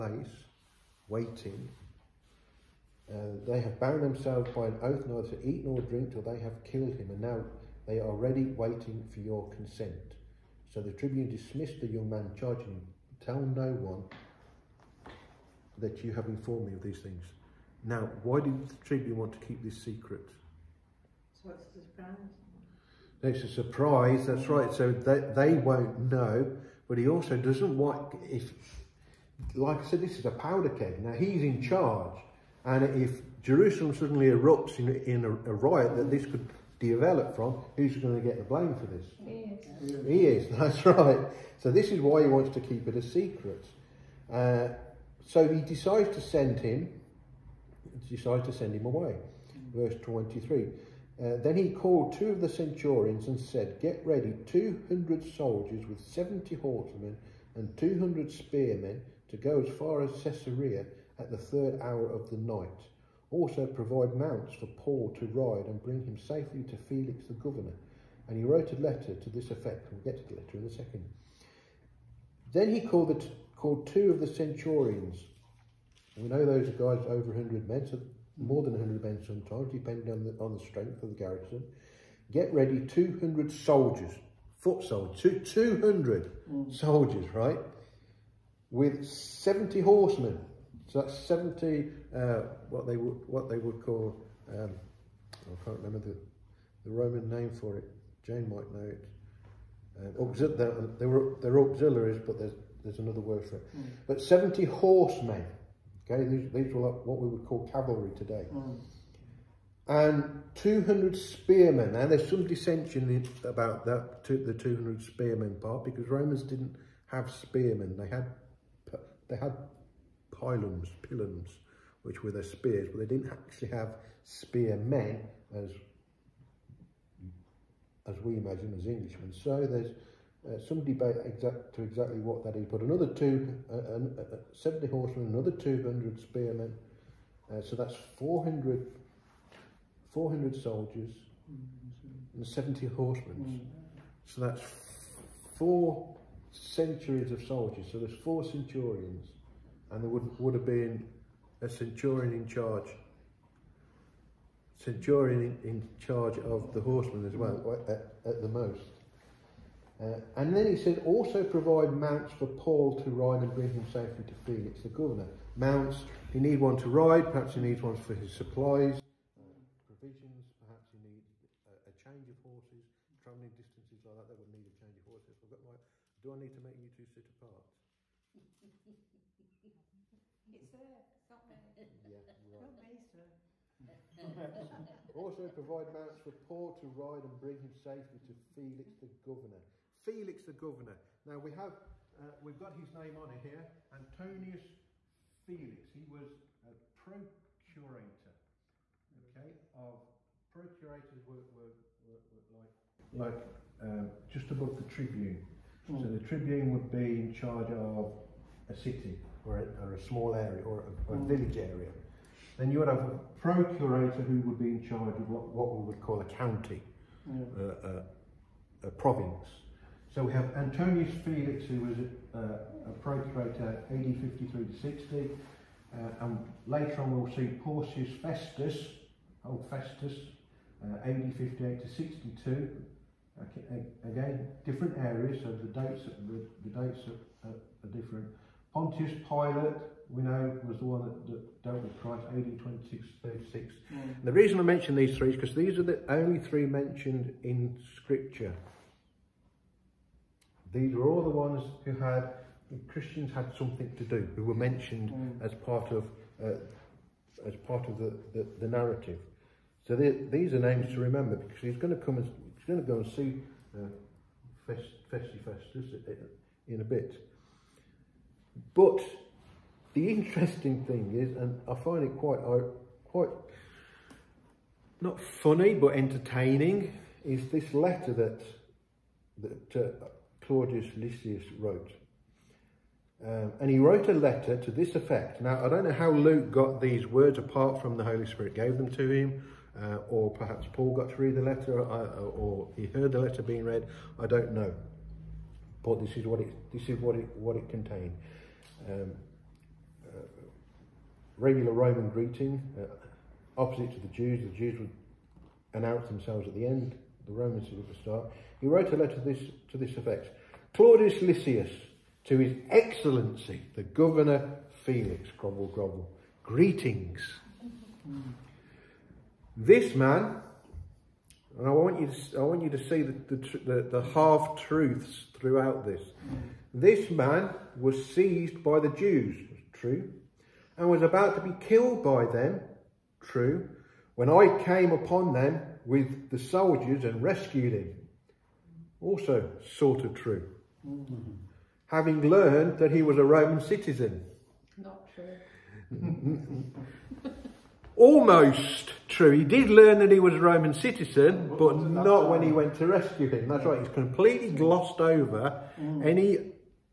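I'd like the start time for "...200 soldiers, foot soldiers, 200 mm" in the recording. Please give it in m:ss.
1:22.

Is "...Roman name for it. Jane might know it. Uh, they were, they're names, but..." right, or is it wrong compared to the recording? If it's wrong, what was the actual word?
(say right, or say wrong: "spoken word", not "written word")
wrong: "auxiliaries", not "names".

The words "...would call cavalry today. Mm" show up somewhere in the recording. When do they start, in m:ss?
1:47.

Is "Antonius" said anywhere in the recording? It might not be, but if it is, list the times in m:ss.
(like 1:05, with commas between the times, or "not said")
3:13, 3:40.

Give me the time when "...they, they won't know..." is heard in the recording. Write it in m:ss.
0:24.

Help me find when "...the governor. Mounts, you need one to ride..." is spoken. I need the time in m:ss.
2:44.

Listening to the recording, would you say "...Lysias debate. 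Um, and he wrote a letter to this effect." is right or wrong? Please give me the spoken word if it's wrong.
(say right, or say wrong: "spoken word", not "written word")
wrong: "wrote", not "debate".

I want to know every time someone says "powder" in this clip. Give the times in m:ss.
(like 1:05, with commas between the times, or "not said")
0:30.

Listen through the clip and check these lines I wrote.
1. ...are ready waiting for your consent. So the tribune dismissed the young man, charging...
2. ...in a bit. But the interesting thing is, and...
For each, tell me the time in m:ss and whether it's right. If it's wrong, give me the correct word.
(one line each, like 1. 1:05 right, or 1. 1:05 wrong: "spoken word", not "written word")
1. 0:07 right
2. 4:26 right.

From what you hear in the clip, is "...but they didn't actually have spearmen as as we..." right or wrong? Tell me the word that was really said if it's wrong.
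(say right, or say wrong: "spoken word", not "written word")
right.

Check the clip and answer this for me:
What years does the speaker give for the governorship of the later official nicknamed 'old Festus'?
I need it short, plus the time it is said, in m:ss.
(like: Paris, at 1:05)
AD 58 to 62, at 3:51.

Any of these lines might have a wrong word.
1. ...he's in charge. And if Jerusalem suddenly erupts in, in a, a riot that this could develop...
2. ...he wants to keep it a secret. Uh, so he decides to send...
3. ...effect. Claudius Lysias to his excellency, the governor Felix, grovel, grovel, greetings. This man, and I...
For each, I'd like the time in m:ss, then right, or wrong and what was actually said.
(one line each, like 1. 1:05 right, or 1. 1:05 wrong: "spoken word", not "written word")
1. 0:31 right
2. 0:42 right
3. 5:09 right.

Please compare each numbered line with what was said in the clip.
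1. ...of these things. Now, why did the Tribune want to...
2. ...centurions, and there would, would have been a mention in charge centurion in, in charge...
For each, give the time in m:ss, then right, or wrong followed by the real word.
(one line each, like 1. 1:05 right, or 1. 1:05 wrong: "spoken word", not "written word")
1. 0:16 right
2. 2:28 wrong: "centurion", not "mention".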